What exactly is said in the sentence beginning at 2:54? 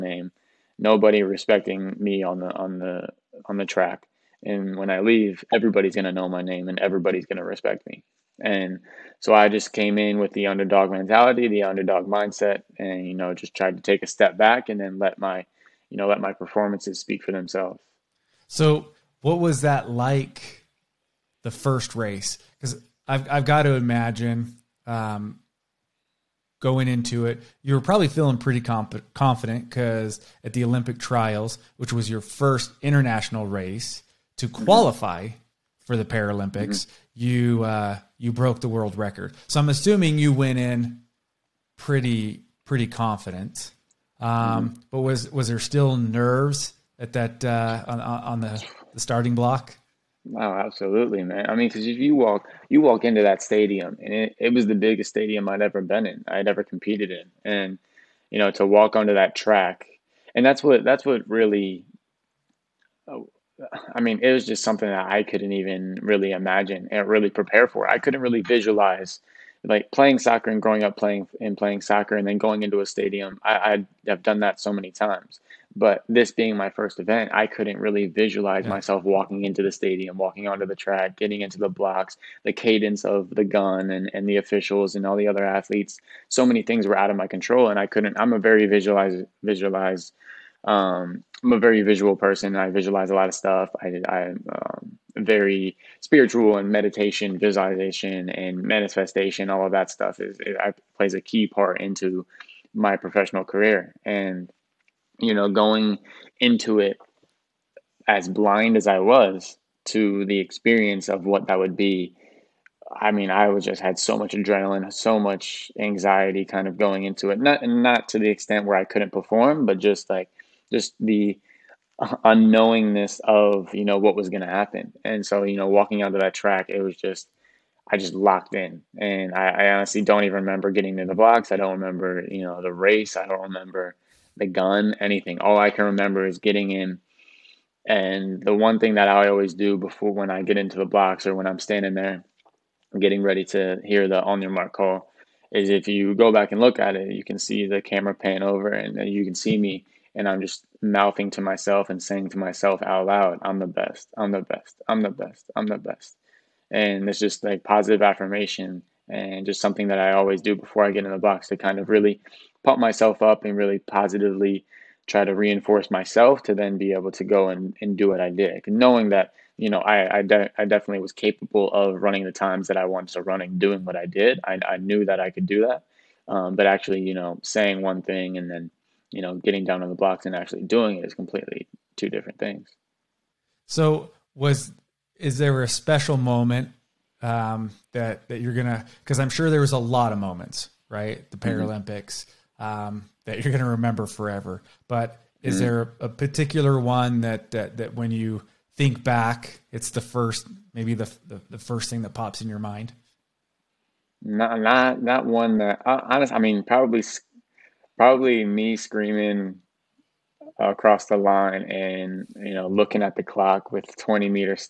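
I, I knew that I could do that.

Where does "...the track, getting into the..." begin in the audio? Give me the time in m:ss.
1:20.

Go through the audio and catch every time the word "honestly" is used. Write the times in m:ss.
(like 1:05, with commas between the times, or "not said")
2:09, 3:25.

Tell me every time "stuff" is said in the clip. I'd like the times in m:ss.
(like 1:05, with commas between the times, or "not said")
1:33, 1:39.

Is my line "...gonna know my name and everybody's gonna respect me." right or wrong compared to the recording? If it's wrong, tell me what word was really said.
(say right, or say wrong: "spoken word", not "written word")
right.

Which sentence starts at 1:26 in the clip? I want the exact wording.
So many things were out of my control, and I couldn't.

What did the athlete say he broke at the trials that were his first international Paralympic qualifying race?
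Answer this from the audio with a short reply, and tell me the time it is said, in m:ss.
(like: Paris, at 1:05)
the world record, at 0:38.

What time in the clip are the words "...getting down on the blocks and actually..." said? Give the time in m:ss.
2:59.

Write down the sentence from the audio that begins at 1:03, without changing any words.
I mean, it was just something that I couldn't even really imagine and really prepare for.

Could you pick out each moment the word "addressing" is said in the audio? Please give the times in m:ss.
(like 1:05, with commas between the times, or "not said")
not said.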